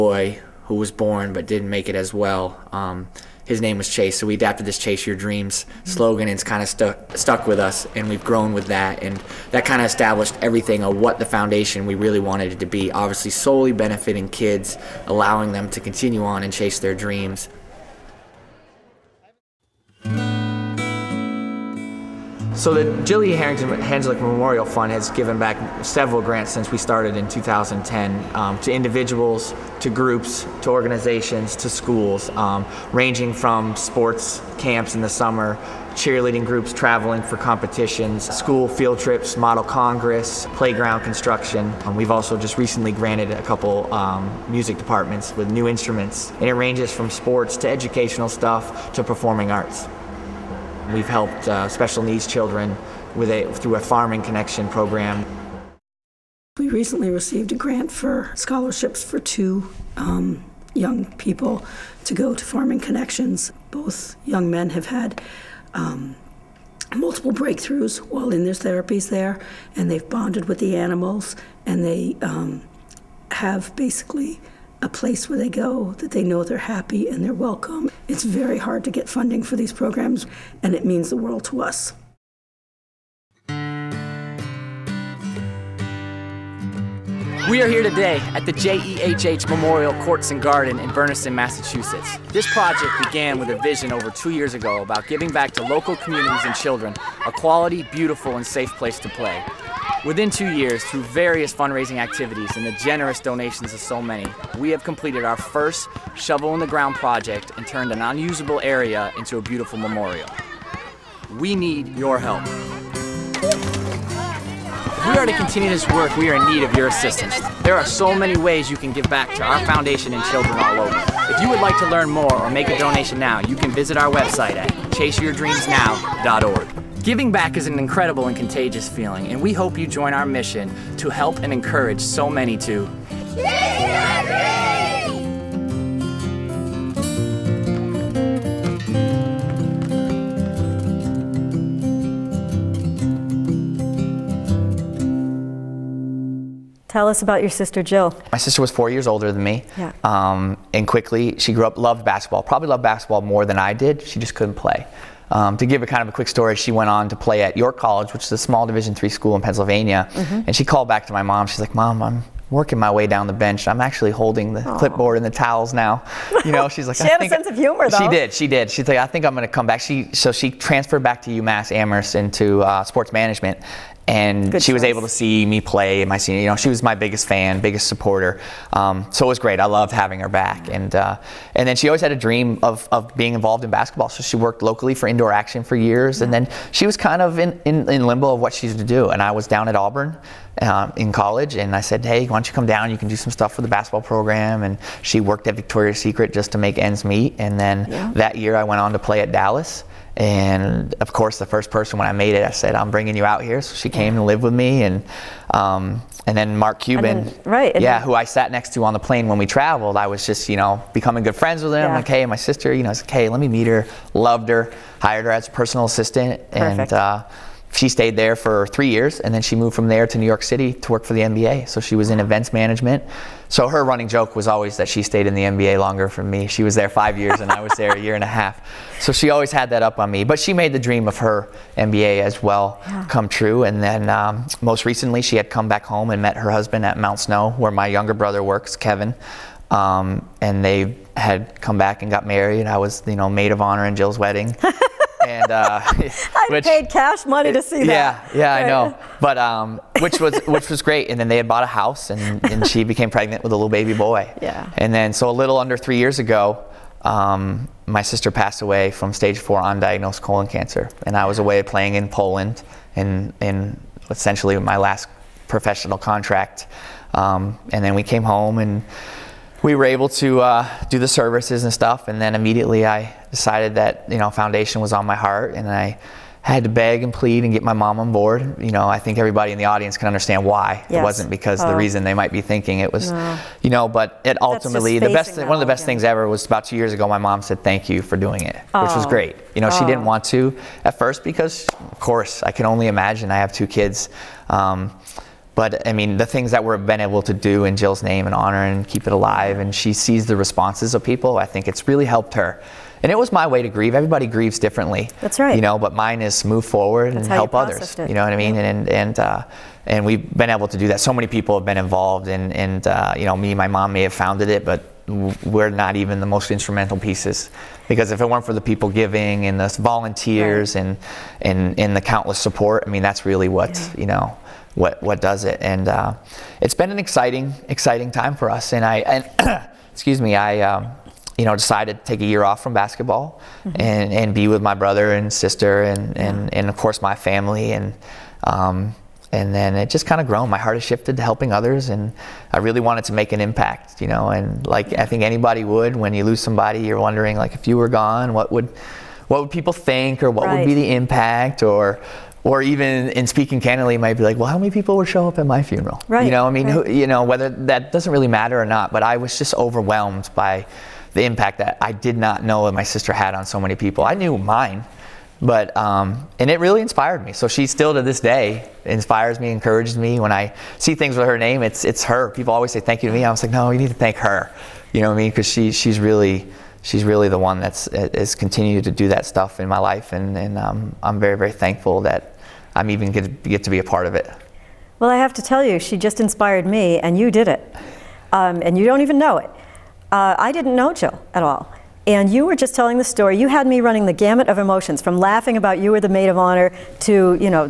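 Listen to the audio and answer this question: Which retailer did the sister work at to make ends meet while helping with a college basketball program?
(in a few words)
Victoria's Secret.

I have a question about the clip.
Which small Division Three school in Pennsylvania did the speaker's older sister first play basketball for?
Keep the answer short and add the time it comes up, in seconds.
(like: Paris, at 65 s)
York College, at 157 s.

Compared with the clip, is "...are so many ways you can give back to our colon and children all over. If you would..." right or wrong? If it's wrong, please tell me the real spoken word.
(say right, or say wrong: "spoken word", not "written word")
wrong: "foundation", not "colon".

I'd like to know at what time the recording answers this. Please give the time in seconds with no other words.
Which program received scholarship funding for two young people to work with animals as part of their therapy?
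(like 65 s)
62 s.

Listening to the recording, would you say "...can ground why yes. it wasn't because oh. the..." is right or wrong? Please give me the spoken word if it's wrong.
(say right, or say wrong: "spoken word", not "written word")
wrong: "understand", not "ground".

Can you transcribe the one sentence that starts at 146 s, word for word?
Tell us about your sister Jill.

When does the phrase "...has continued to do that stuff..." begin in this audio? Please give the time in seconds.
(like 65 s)
377 s.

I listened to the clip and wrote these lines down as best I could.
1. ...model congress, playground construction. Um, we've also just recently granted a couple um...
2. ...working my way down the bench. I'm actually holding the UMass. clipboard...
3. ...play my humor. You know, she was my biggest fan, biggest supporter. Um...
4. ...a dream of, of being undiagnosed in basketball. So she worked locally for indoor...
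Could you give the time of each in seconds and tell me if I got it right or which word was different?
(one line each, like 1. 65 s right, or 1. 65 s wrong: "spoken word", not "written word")
1. 39 s right
2. 162 s wrong: "Aww", not "UMass"
3. 175 s wrong: "senior", not "humor"
4. 182 s wrong: "involved", not "undiagnosed".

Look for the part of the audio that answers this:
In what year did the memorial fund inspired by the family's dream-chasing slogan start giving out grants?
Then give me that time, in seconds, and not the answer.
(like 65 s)
27 s.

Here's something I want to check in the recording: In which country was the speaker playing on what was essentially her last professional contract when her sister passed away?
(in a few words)
Poland.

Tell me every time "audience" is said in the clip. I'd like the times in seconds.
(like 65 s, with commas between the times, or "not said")
279 s.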